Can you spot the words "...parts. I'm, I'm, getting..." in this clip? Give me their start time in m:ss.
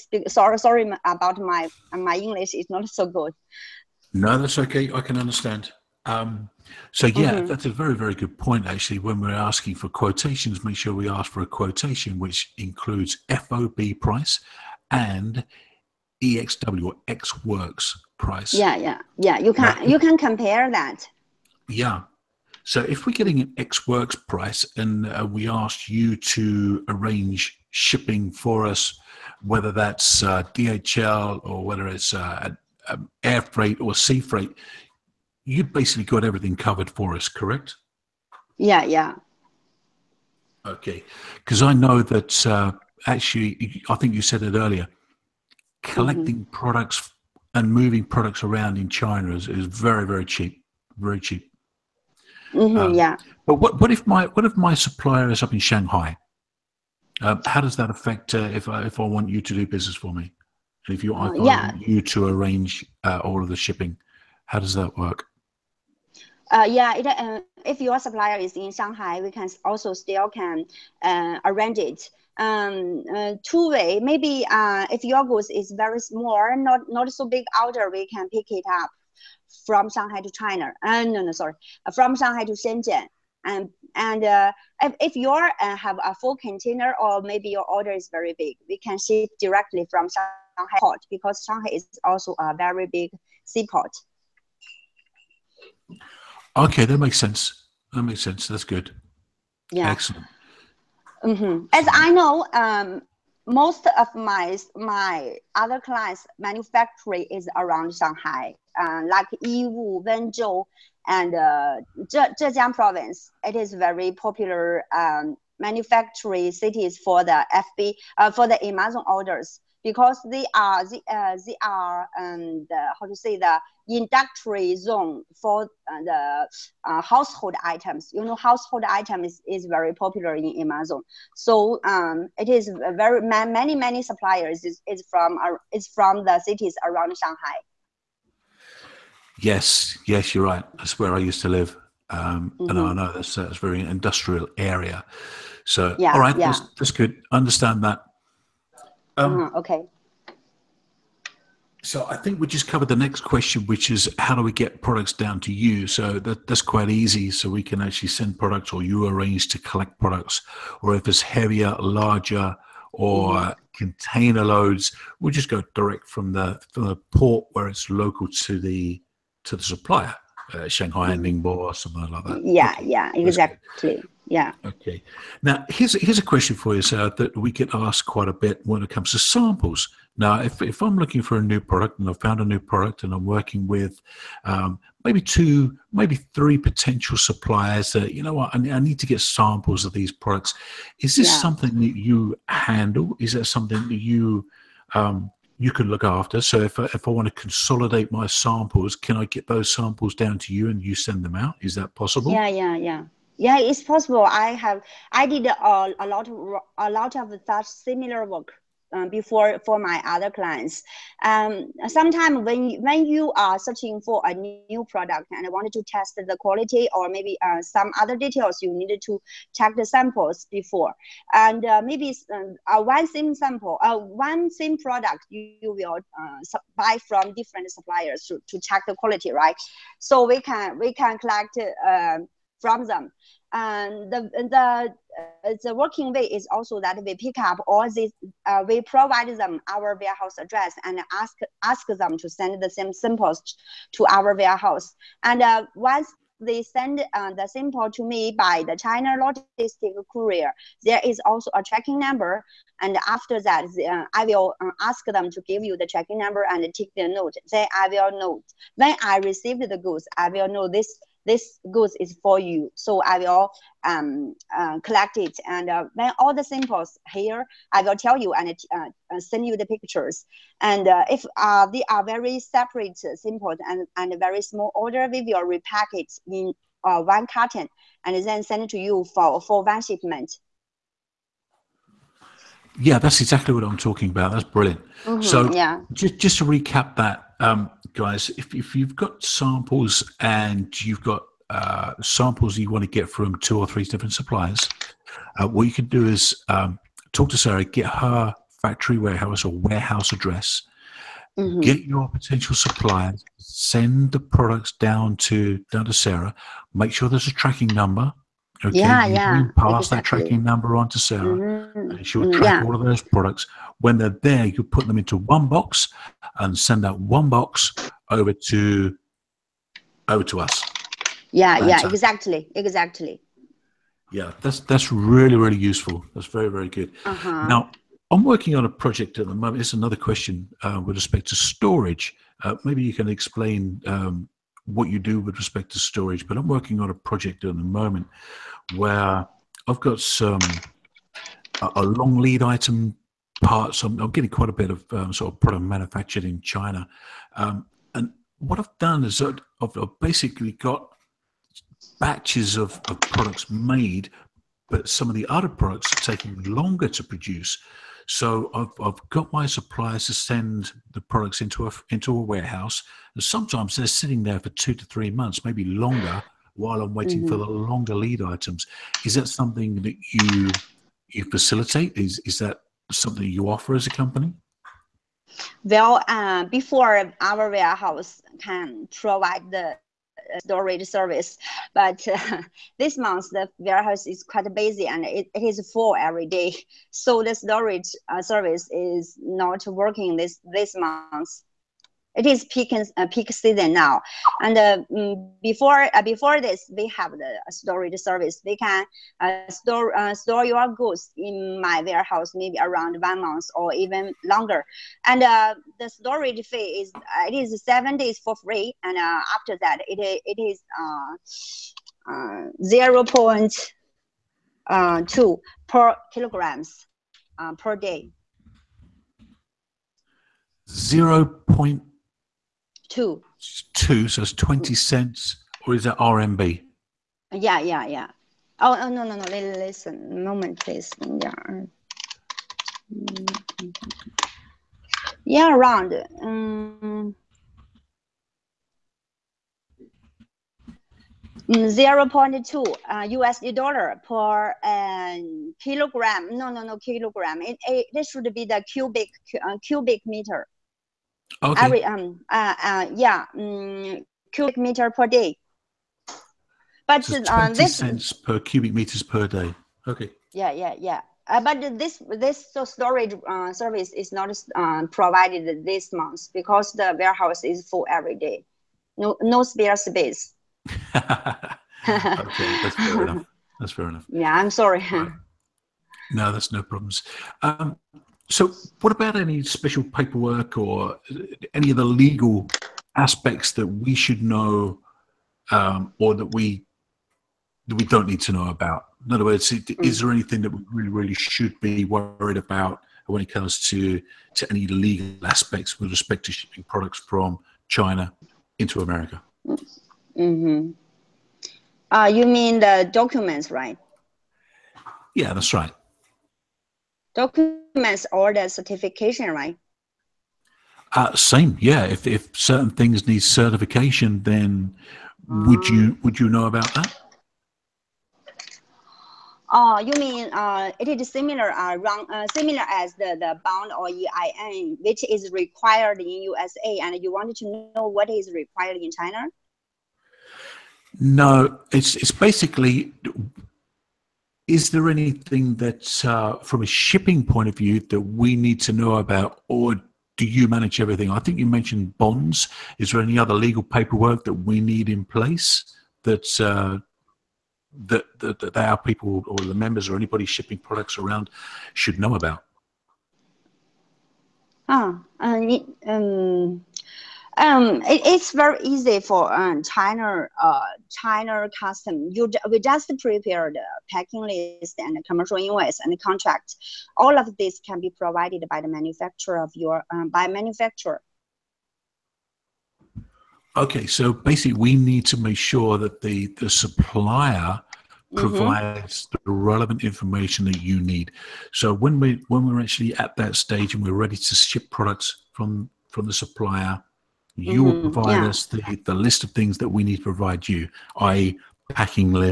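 5:43.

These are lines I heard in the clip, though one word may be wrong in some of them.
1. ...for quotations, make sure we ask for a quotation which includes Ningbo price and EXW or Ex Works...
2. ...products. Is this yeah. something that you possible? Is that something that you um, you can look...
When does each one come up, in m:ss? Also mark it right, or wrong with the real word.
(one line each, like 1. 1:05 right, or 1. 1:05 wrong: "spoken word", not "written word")
1. 0:09 wrong: "FOB", not "Ningbo"
2. 3:10 wrong: "handle", not "possible".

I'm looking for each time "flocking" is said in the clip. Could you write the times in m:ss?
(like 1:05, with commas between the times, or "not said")
not said.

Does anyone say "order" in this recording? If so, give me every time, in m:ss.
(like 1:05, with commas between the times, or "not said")
1:17, 1:27, 1:59, 4:34.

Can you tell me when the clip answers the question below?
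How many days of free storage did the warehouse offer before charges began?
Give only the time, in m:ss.
6:47.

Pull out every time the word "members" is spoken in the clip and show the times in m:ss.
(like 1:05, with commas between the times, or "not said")
9:09.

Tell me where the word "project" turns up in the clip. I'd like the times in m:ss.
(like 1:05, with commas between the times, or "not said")
5:28, 5:36.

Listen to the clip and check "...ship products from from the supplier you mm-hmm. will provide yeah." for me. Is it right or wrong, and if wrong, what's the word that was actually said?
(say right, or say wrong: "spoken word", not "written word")
right.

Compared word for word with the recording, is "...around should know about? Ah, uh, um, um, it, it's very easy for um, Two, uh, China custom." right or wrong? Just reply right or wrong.
wrong.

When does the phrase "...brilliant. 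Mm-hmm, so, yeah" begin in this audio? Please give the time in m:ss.
4:44.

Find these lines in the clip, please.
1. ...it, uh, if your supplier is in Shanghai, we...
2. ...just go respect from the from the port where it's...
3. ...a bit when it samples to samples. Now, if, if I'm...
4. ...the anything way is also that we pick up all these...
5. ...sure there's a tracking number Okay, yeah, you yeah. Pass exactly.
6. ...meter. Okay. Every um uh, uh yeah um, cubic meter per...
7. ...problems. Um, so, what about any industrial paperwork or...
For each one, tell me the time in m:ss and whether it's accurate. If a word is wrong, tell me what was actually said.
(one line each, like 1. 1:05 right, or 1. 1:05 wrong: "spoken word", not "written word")
1. 1:06 right
2. 2:45 wrong: "direct", not "respect"
3. 2:58 wrong: "comes", not "samples"
4. 3:55 wrong: "working", not "anything"
5. 5:06 right
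6. 7:30 right
7. 7:56 wrong: "special", not "industrial".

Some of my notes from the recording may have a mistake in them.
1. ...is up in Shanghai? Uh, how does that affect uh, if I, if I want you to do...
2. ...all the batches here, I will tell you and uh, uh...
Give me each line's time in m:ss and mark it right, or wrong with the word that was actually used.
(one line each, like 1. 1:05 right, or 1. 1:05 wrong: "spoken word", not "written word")
1. 0:55 right
2. 4:26 wrong: "samples", not "batches".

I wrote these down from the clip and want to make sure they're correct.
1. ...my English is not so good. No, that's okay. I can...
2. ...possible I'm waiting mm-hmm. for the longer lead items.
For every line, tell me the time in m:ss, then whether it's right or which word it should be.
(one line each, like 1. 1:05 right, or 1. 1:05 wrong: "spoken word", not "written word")
1. 0:01 right
2. 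6:06 wrong: "while", not "possible".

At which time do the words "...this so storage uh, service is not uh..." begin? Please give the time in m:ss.
7:42.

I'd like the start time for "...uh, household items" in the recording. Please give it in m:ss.
2:06.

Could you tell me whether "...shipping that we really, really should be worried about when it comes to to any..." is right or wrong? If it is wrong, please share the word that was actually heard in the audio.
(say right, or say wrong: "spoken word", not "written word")
wrong: "anything", not "shipping".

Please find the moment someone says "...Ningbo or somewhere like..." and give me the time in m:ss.
2:51.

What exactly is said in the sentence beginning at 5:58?
So I've, I've got my suppliers to send the products into a, into a warehouse.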